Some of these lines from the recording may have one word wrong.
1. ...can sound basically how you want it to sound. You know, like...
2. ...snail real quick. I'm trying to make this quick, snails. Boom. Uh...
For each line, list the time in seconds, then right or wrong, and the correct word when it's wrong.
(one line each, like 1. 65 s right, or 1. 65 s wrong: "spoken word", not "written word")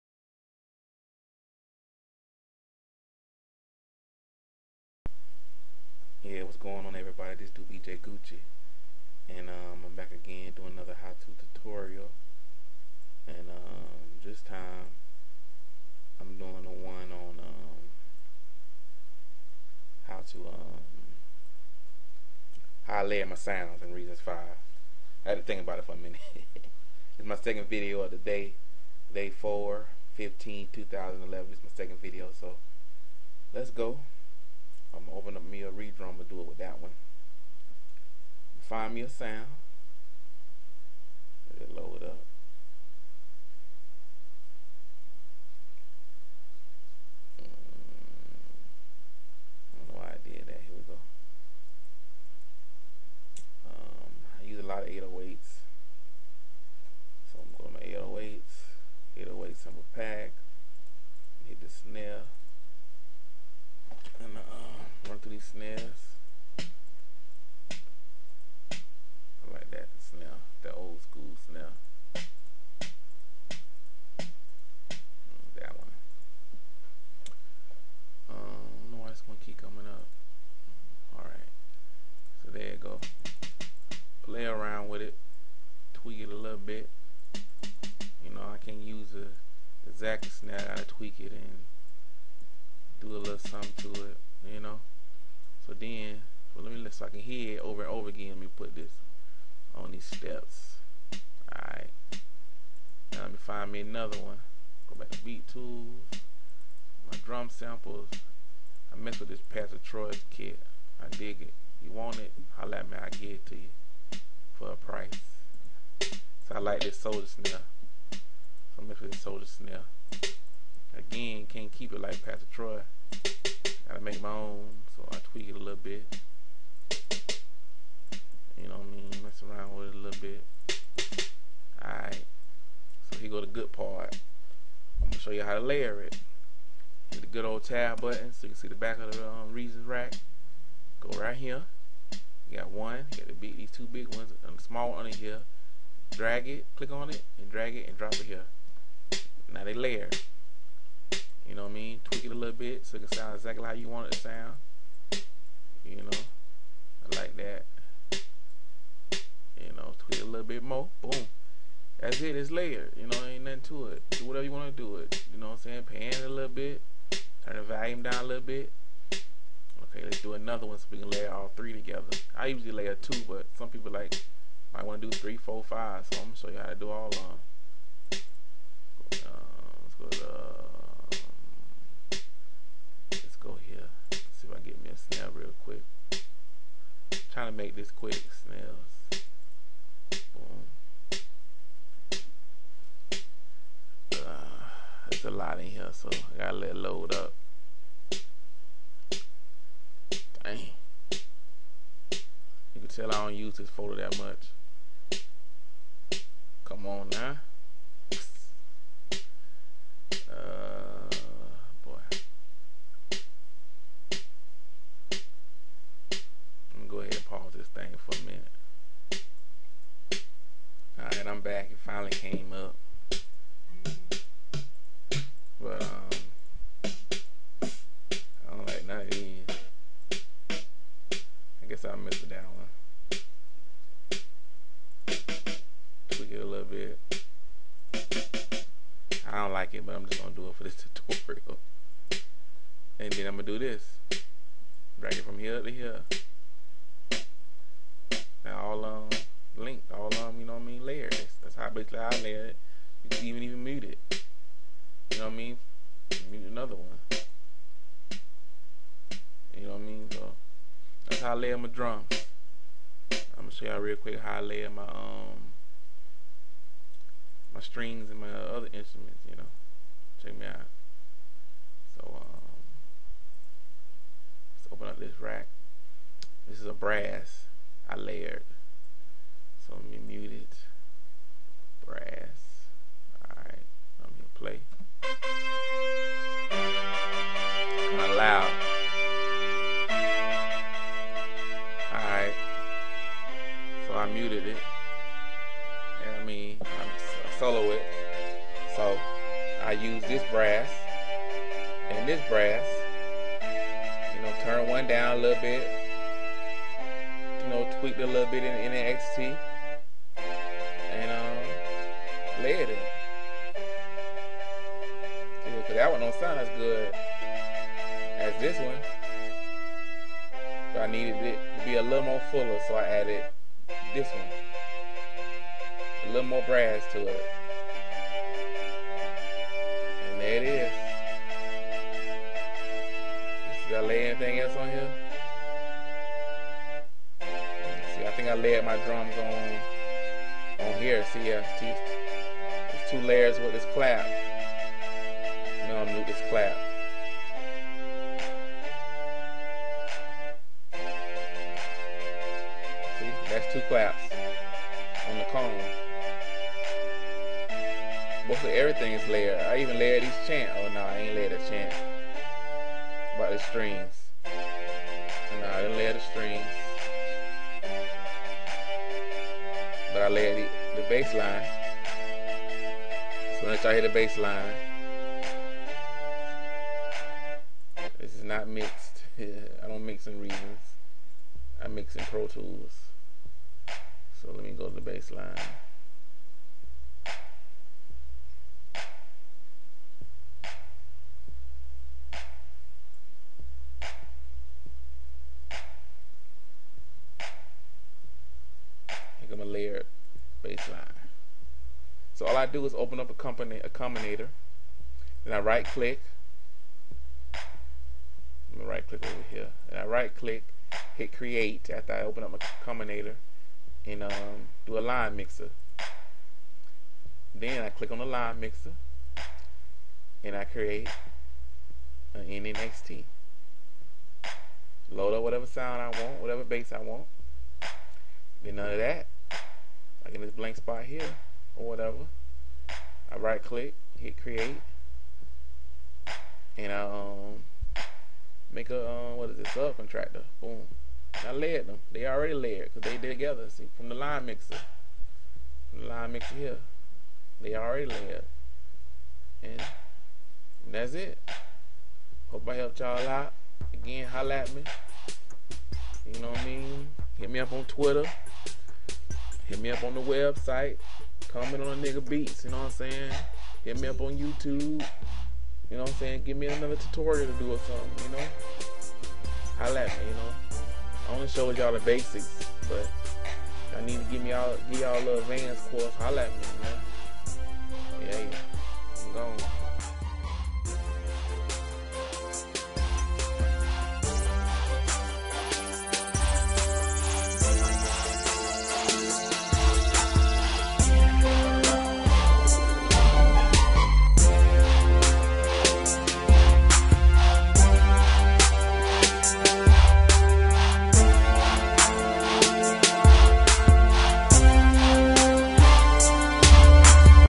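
1. 153 s wrong: "exactly", not "basically"
2. 185 s right.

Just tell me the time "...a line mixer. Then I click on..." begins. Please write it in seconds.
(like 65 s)
414 s.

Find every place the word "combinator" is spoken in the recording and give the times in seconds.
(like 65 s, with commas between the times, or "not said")
403 s, 412 s.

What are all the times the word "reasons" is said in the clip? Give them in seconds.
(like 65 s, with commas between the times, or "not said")
23 s, 139 s, 380 s.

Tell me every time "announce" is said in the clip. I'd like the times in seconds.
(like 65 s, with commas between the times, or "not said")
not said.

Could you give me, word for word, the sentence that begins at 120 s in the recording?
Again, can't keep it like Pastor Troy.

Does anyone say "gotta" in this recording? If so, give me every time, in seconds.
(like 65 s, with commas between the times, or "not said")
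123 s, 196 s.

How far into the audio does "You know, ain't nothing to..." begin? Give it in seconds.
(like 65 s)
162 s.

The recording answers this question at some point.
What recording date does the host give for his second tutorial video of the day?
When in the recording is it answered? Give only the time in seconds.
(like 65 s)
29 s.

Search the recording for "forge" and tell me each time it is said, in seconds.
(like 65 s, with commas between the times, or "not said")
not said.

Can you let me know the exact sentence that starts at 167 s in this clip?
Turn the volume down a little bit.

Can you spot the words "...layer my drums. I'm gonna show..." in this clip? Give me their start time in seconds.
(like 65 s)
261 s.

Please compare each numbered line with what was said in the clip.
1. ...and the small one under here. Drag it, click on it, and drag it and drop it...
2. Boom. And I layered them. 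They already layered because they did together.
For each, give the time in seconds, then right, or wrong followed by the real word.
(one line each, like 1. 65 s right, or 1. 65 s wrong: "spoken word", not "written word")
1. 144 s right
2. 440 s right.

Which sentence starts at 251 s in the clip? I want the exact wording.
That's how basically I layer it.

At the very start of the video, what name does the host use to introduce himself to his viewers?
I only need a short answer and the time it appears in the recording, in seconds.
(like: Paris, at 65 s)
BJ Gucci, at 7 s.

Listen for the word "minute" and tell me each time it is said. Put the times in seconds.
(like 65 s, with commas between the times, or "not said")
25 s.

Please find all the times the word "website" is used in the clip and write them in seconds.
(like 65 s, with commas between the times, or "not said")
460 s.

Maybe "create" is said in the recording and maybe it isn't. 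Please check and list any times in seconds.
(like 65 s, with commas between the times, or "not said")
411 s, 420 s, 434 s.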